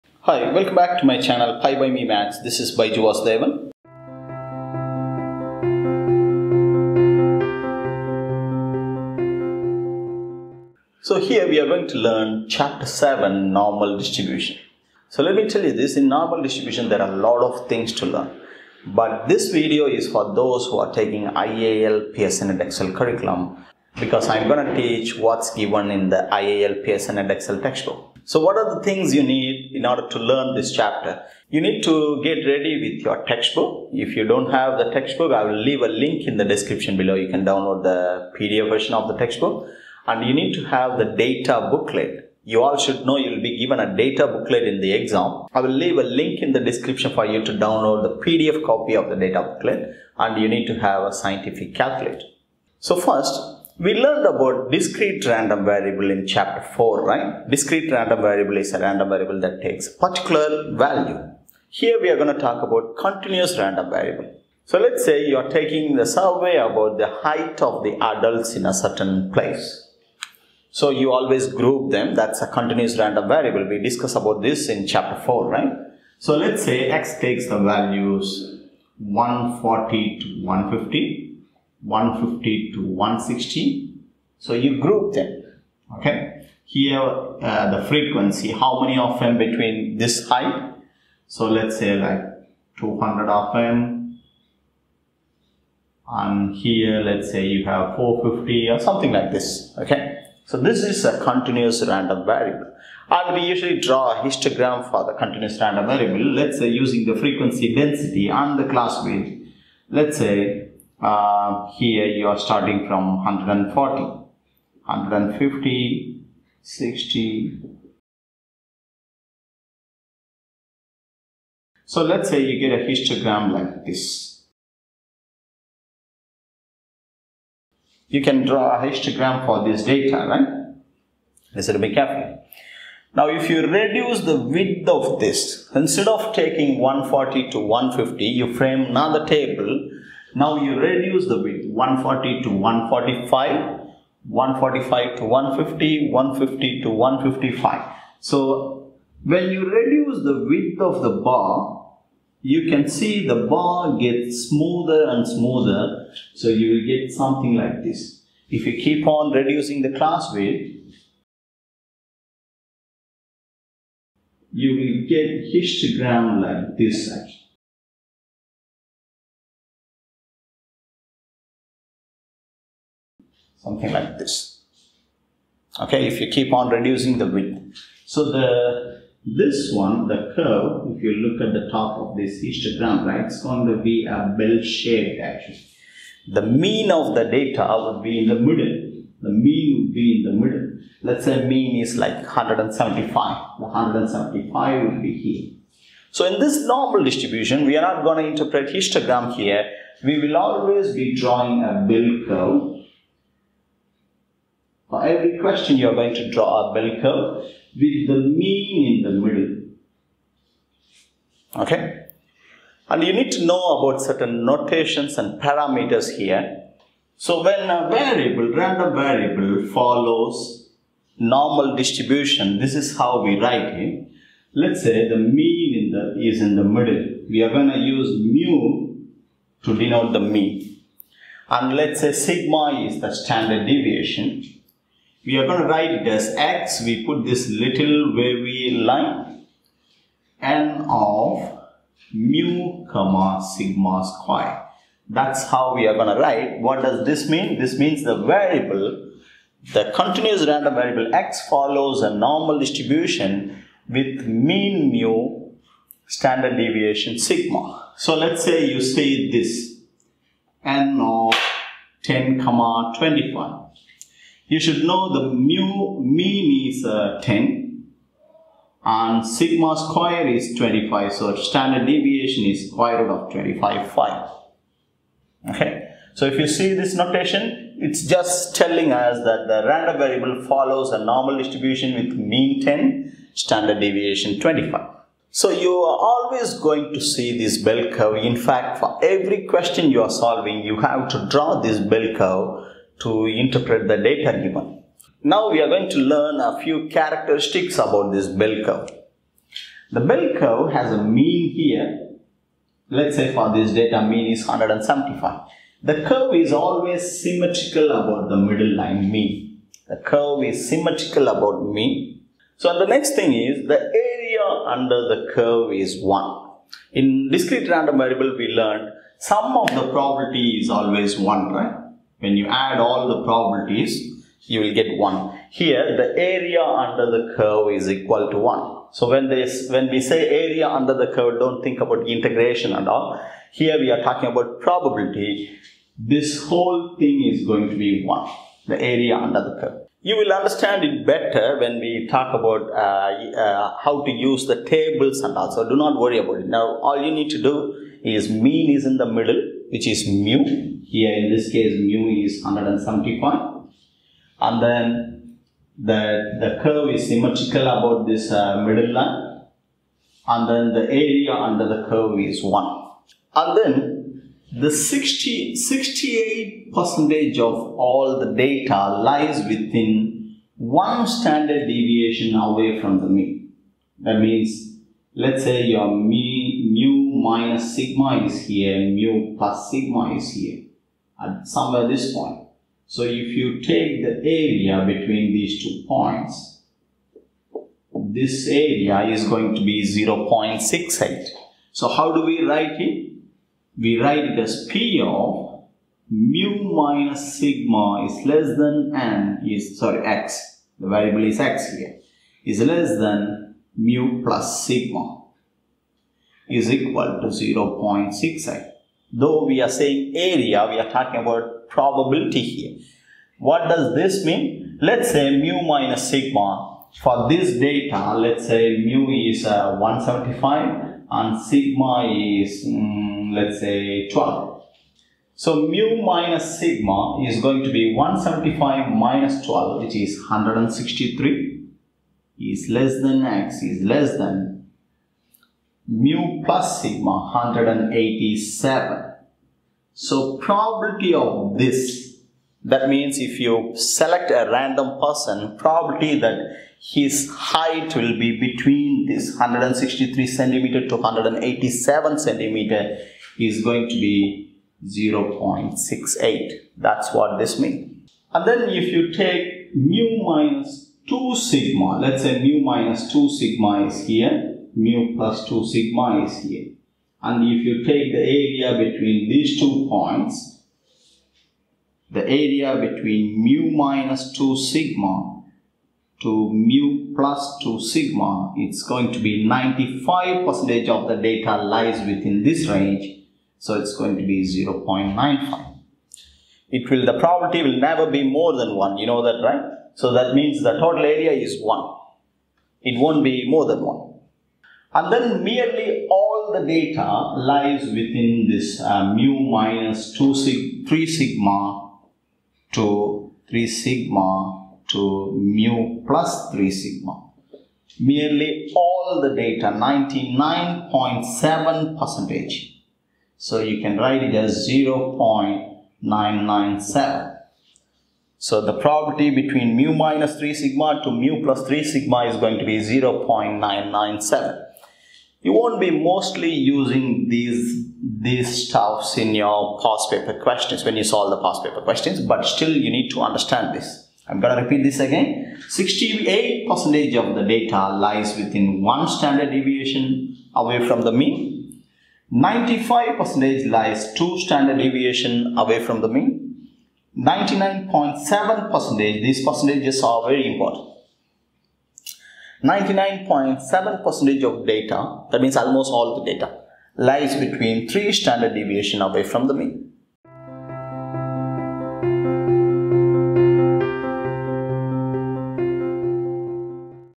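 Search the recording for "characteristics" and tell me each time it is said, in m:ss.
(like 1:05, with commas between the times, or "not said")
4:56.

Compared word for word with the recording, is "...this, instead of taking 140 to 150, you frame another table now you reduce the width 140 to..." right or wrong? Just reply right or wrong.
right.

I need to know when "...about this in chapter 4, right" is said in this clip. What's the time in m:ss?
1:14.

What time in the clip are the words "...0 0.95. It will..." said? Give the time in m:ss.
8:04.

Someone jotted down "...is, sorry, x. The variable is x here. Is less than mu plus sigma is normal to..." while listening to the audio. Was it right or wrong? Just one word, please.
wrong.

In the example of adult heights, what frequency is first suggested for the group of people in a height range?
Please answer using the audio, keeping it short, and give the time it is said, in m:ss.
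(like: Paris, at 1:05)
200, at 1:32.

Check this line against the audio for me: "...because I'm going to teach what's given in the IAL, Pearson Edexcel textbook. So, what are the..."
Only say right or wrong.
right.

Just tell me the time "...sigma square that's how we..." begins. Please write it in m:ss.
4:03.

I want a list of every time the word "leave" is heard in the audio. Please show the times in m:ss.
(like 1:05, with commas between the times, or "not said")
0:35, 0:45.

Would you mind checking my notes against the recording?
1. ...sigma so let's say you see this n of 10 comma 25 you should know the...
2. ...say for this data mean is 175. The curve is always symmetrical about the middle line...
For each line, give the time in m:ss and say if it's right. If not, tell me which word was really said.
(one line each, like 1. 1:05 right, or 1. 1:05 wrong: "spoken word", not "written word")
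1. 4:17 right
2. 5:03 right.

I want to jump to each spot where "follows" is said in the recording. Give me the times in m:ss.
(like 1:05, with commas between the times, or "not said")
3:39, 4:11, 4:40.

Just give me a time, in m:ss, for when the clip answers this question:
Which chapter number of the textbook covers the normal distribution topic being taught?
0:12.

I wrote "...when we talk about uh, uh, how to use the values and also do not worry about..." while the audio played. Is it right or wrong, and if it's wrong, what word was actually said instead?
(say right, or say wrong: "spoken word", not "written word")
wrong: "tables", not "values".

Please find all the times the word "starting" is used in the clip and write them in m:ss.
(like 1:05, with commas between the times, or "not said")
1:52.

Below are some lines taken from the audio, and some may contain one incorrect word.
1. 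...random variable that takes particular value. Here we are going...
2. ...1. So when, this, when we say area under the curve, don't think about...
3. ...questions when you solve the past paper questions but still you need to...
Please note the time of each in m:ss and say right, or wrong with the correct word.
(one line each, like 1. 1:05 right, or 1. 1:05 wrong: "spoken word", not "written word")
1. 0:58 right
2. 5:28 right
3. 8:50 right.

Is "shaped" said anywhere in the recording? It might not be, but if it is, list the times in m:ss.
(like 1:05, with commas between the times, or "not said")
3:04.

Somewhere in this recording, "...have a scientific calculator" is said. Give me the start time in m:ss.
0:50.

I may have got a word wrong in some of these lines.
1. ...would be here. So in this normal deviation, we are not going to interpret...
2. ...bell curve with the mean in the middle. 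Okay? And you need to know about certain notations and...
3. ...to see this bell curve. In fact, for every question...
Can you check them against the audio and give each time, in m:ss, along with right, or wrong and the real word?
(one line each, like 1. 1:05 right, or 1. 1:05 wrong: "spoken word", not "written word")
1. 3:14 wrong: "distribution", not "deviation"
2. 3:26 right
3. 4:46 right.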